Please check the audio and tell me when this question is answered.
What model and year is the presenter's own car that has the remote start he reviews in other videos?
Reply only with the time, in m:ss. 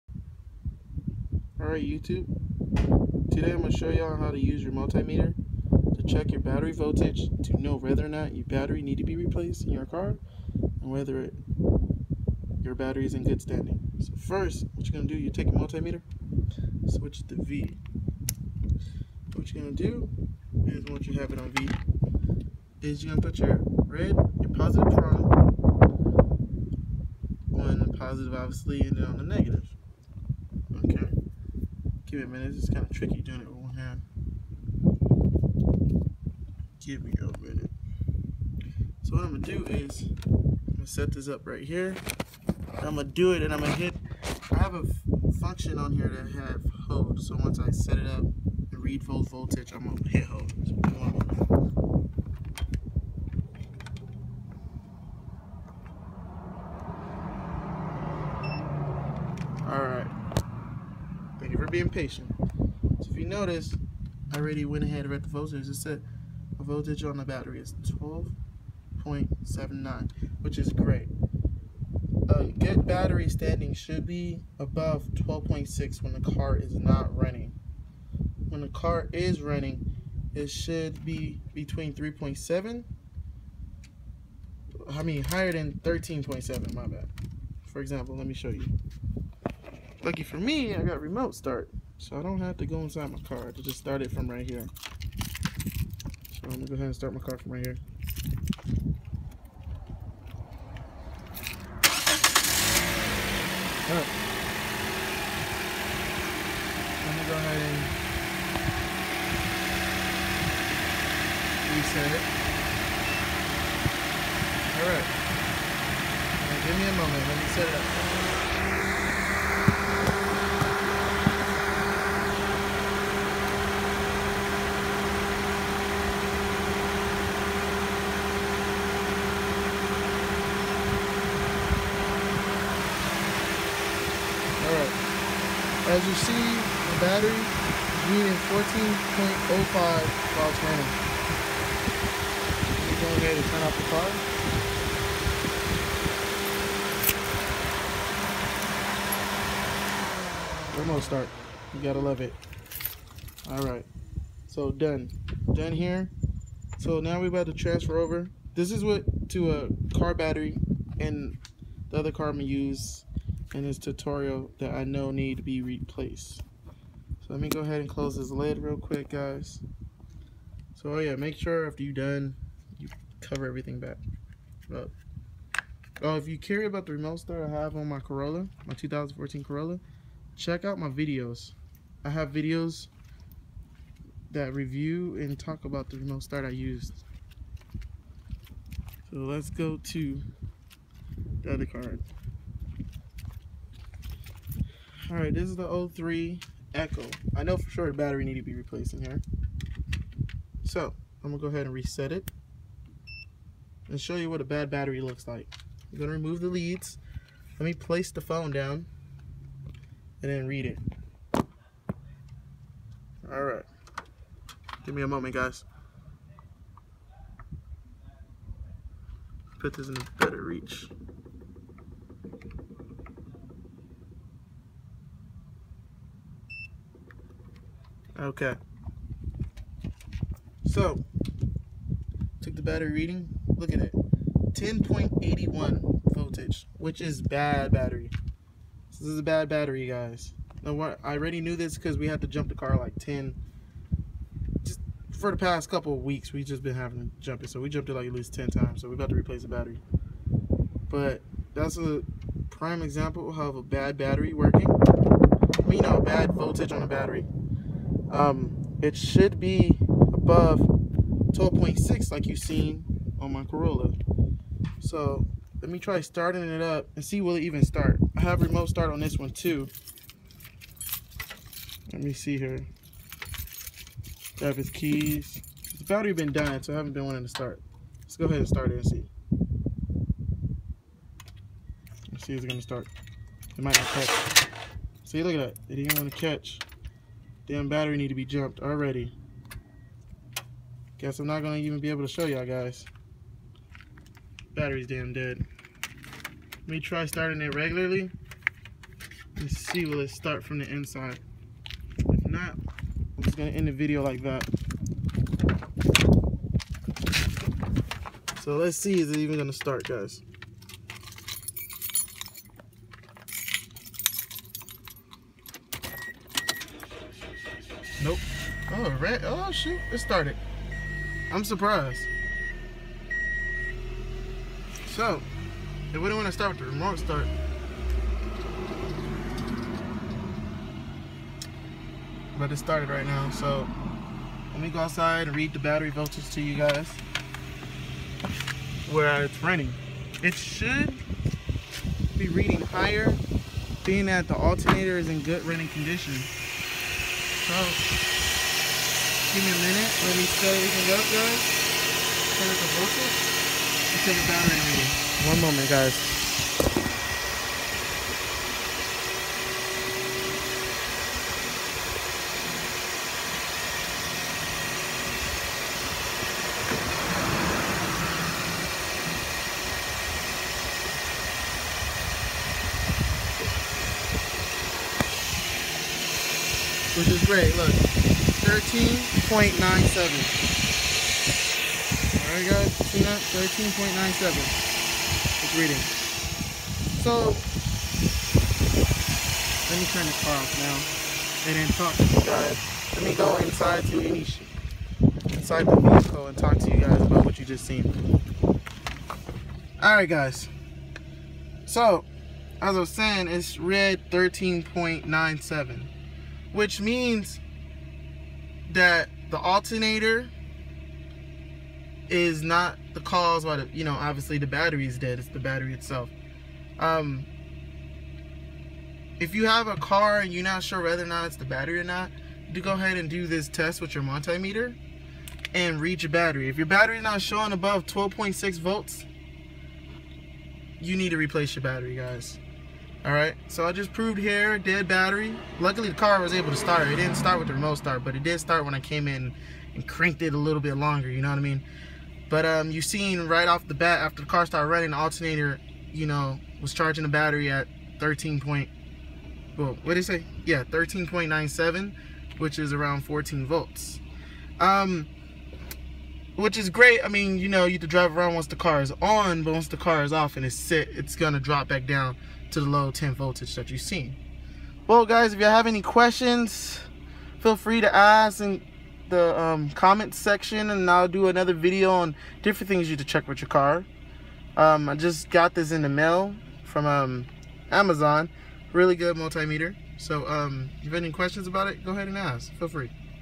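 2:58.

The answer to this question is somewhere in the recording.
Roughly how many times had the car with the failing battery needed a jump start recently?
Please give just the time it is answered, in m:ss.
4:08.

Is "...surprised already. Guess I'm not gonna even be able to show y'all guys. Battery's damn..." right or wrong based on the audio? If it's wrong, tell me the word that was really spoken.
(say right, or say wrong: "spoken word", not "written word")
wrong: "jumped", not "surprised".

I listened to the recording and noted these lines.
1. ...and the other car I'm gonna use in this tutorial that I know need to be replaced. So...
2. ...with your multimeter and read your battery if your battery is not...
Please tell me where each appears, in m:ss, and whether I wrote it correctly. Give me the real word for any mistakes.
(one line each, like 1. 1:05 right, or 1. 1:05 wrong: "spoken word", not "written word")
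1. 2:41 right
2. 7:03 right.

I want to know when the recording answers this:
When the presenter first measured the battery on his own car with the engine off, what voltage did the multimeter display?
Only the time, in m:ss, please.
1:09.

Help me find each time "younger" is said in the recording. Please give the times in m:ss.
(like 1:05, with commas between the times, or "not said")
not said.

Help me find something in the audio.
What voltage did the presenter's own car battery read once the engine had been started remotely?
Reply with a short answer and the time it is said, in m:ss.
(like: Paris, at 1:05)
14.05, at 2:18.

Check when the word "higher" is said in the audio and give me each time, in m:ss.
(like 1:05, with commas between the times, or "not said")
1:25, 5:42.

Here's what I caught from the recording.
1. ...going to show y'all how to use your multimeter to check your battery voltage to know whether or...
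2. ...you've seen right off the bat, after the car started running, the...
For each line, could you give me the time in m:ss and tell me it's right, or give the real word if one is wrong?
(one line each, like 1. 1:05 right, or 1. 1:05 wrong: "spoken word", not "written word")
1. 0:03 right
2. 7:22 right.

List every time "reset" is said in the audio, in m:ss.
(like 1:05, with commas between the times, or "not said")
1:51, 3:21.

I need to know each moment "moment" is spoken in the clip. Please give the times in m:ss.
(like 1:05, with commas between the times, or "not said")
1:56, 3:35, 5:55.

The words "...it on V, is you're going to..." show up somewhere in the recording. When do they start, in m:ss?
0:21.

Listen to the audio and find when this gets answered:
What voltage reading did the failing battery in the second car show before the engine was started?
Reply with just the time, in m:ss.
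3:54.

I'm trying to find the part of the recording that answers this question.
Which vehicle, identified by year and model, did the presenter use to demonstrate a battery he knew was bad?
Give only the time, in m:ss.
3:15.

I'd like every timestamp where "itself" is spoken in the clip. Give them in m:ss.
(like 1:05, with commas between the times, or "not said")
6:55.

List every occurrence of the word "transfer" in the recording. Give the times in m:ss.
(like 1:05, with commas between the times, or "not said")
2:37.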